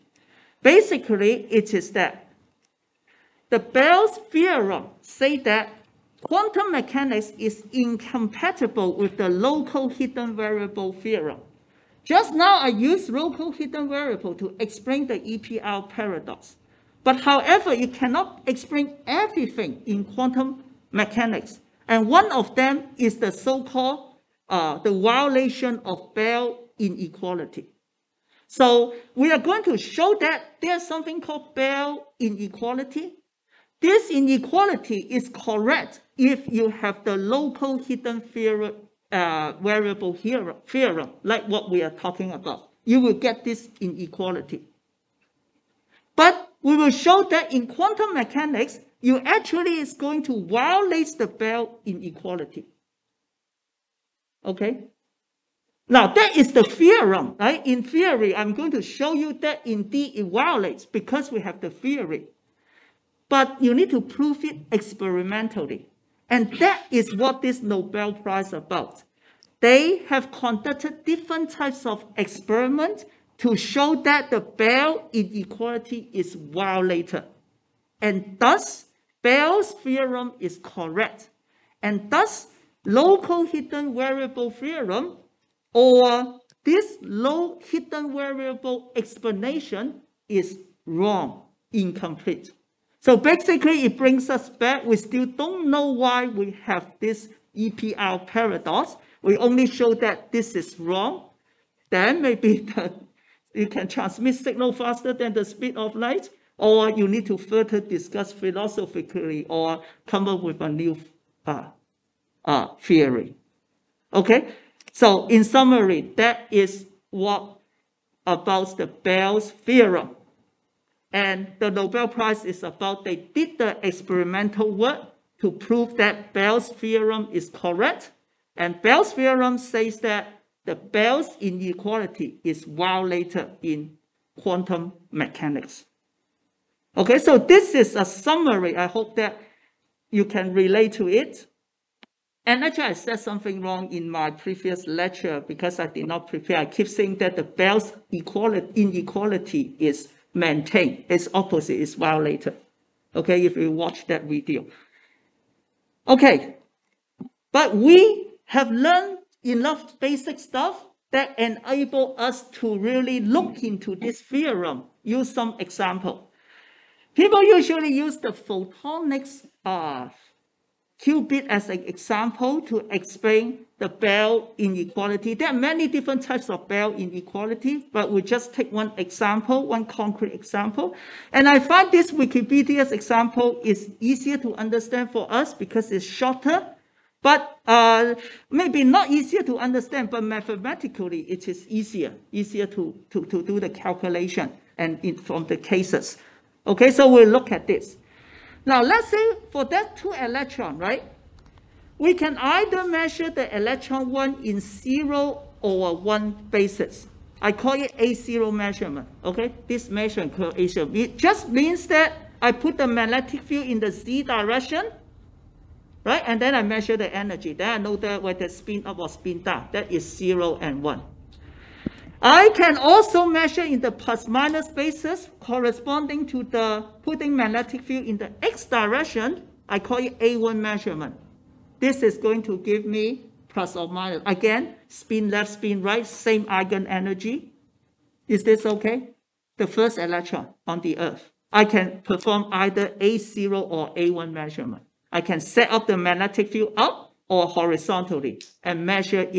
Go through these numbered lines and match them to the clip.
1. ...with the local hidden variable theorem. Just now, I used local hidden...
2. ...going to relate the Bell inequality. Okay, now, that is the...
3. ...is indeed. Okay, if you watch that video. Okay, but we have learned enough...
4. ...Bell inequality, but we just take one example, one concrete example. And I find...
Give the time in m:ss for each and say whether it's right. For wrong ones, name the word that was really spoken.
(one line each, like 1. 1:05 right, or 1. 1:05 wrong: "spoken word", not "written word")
1. 0:08 right
2. 0:49 wrong: "violate", not "relate"
3. 2:31 wrong: "violated", not "indeed"
4. 2:56 right.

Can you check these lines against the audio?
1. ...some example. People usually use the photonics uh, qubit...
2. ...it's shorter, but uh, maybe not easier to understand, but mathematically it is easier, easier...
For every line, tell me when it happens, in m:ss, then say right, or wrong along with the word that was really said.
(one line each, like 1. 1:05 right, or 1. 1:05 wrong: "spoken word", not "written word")
1. 2:45 right
2. 3:05 right.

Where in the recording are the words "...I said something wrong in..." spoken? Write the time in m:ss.
2:22.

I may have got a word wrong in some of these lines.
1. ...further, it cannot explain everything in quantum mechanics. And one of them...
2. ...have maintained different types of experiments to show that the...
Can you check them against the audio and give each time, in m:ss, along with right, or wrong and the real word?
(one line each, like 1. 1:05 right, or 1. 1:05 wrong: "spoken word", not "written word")
1. 0:17 wrong: "however", not "further"
2. 1:10 wrong: "conducted", not "maintained".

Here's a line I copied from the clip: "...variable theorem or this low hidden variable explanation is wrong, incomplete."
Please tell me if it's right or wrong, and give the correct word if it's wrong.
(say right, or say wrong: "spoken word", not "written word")
right.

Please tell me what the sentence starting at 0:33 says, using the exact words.
This inequality is correct if you have the local hidden uh, variable here, theorem, like what we are talking about.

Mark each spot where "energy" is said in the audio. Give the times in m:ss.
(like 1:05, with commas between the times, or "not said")
3:37, 3:56.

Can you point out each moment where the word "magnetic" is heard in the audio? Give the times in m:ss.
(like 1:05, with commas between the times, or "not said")
3:32, 3:47, 4:05.